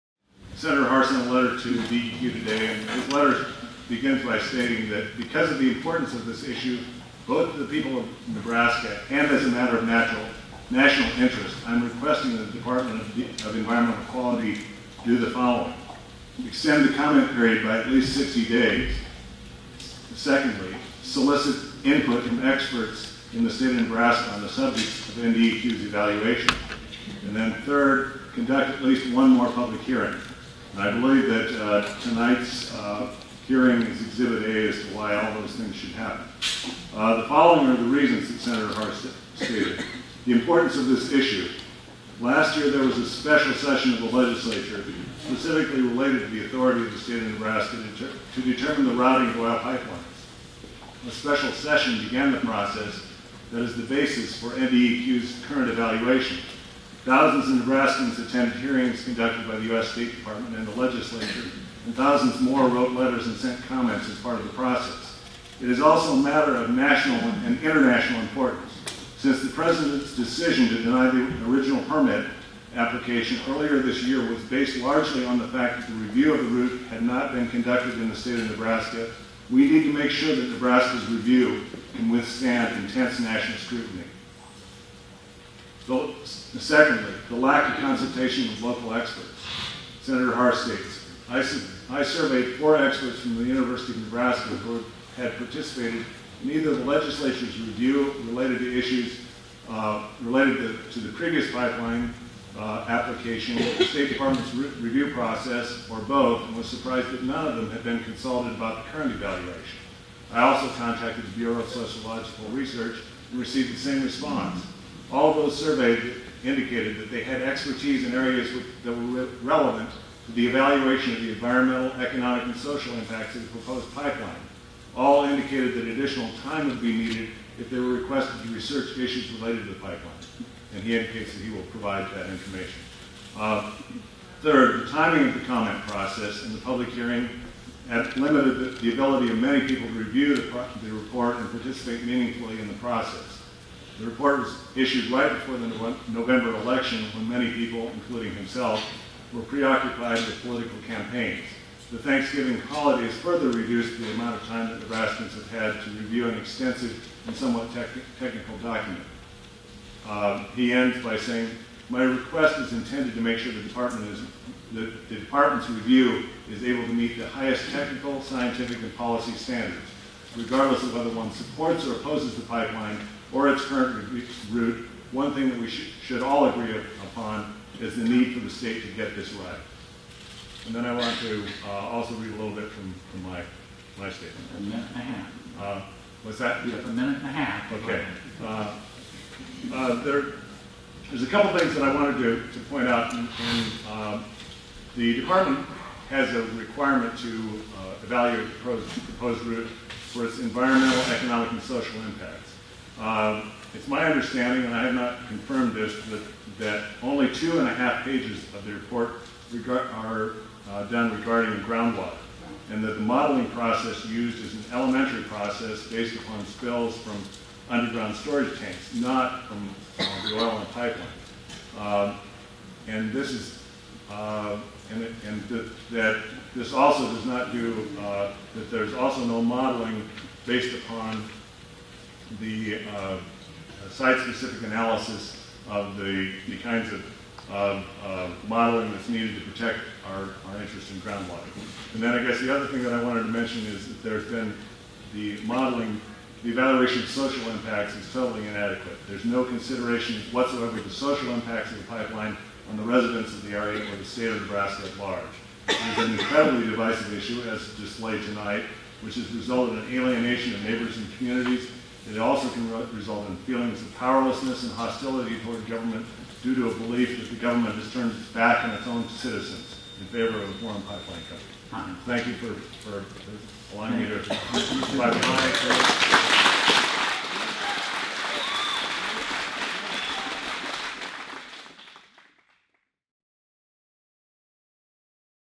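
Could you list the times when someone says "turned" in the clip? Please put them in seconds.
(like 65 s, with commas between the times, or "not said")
267 s.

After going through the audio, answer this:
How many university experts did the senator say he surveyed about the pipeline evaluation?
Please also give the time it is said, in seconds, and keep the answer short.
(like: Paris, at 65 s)
4, at 92 s.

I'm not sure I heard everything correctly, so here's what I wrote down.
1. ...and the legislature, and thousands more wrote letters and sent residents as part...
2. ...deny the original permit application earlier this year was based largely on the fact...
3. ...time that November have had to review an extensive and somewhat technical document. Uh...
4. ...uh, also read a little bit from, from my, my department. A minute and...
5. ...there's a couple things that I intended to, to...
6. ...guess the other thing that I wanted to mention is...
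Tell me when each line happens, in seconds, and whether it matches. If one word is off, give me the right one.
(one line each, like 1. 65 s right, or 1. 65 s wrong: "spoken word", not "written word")
1. 60 s wrong: "comments", not "residents"
2. 70 s right
3. 154 s wrong: "Nebraskans", not "November"
4. 181 s wrong: "statement", not "department"
5. 191 s wrong: "wanted", not "intended"
6. 242 s right.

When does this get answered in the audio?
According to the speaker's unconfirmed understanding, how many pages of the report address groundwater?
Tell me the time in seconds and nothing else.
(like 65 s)
207 s.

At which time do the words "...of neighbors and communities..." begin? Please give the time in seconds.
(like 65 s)
260 s.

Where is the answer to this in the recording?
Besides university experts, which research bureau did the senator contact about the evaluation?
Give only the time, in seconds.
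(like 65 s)
111 s.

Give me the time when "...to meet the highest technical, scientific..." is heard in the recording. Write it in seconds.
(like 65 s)
166 s.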